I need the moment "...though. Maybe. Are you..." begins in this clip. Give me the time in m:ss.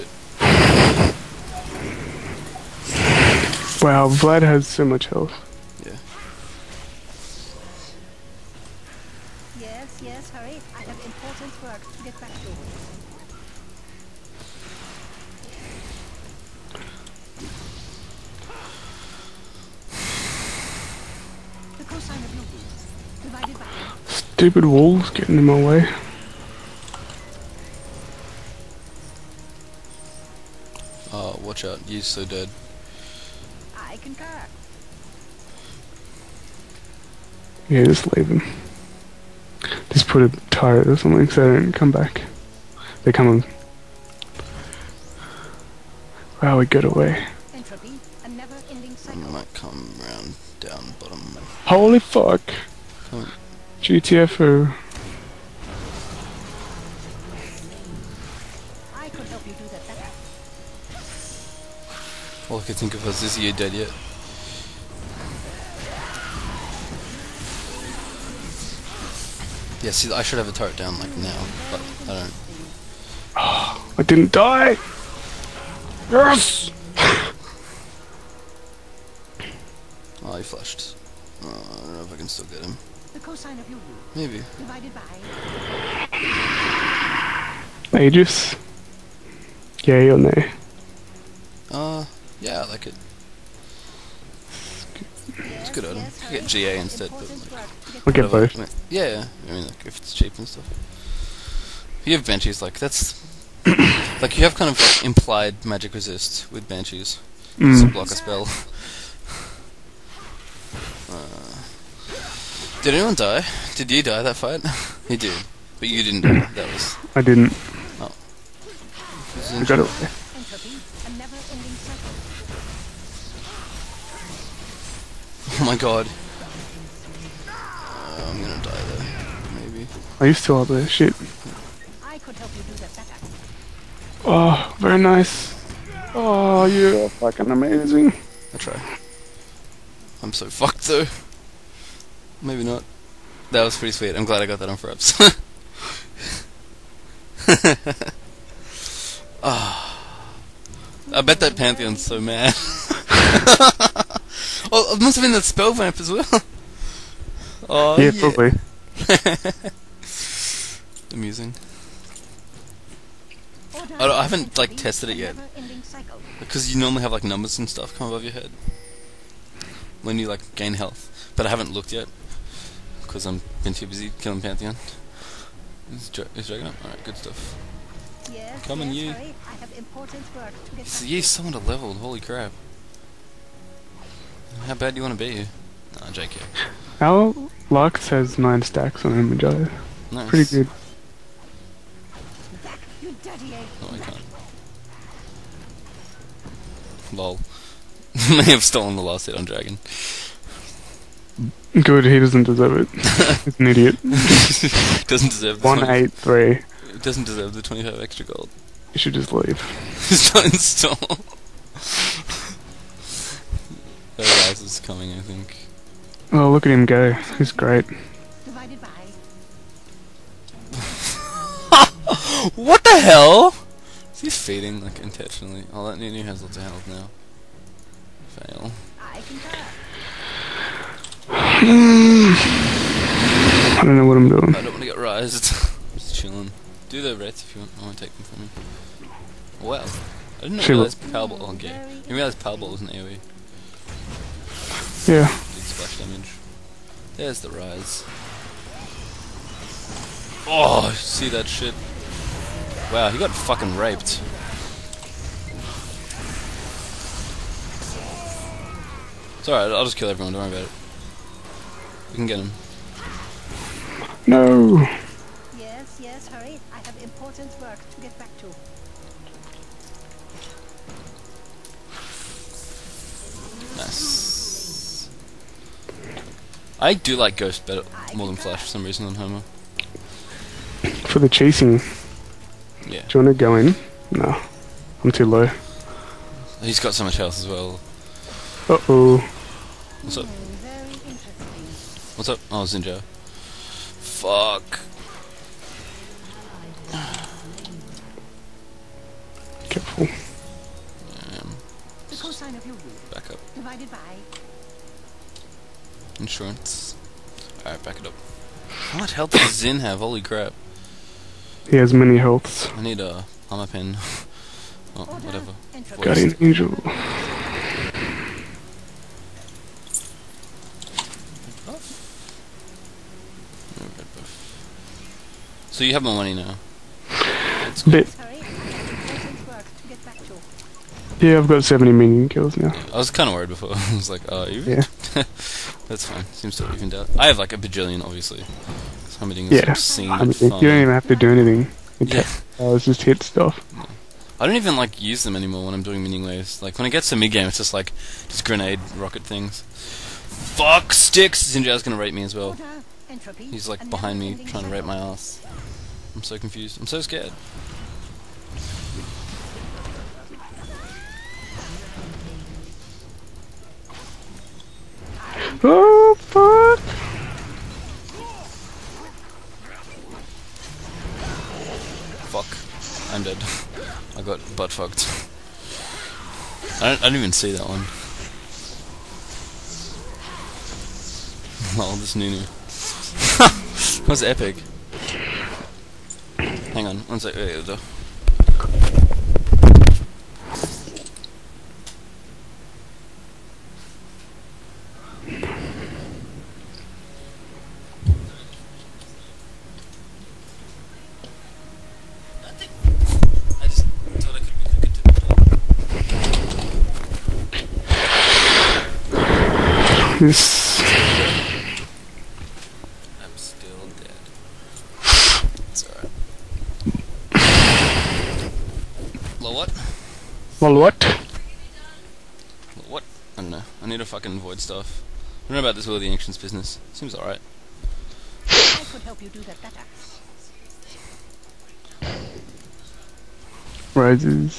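2:09.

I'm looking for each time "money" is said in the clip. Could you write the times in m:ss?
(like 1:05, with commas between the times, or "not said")
5:26.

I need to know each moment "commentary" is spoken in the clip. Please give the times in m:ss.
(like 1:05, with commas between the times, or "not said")
not said.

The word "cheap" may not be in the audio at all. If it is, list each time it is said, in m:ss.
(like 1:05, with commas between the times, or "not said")
1:40.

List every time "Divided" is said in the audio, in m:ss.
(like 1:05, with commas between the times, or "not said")
1:24, 5:03.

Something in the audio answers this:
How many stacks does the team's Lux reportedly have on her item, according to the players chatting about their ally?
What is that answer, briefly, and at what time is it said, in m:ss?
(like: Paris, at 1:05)
9, at 3:08.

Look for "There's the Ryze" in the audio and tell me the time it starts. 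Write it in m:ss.
4:07.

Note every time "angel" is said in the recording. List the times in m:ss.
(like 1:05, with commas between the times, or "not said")
5:16.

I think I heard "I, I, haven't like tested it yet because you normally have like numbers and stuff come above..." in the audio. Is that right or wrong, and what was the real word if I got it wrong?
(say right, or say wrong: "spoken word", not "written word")
right.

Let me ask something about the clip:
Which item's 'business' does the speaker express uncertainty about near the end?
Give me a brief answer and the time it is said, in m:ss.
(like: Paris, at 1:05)
Will of the Ancients, at 7:05.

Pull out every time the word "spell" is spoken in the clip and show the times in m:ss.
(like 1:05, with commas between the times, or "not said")
1:48, 2:35.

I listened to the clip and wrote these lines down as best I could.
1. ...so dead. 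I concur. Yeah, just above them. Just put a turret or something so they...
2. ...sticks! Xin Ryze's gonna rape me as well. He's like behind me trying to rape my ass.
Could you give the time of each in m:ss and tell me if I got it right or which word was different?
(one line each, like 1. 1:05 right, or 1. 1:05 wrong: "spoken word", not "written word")
1. 0:32 wrong: "leave", not "above"
2. 5:50 wrong: "Zhao", not "Ryze".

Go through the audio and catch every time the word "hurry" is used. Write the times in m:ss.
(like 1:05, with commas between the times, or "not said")
0:10, 4:26.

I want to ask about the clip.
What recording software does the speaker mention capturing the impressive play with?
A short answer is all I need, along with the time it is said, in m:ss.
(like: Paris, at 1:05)
Fraps, at 2:24.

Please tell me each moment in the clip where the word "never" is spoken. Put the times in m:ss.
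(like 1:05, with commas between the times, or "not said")
not said.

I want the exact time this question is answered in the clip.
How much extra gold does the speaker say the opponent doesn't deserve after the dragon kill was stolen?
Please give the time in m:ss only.
3:27.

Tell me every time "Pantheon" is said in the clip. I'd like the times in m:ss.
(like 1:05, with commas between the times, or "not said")
2:31, 2:54.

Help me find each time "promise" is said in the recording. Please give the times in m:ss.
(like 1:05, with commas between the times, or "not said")
not said.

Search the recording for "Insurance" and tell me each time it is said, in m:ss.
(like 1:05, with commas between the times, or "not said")
5:06.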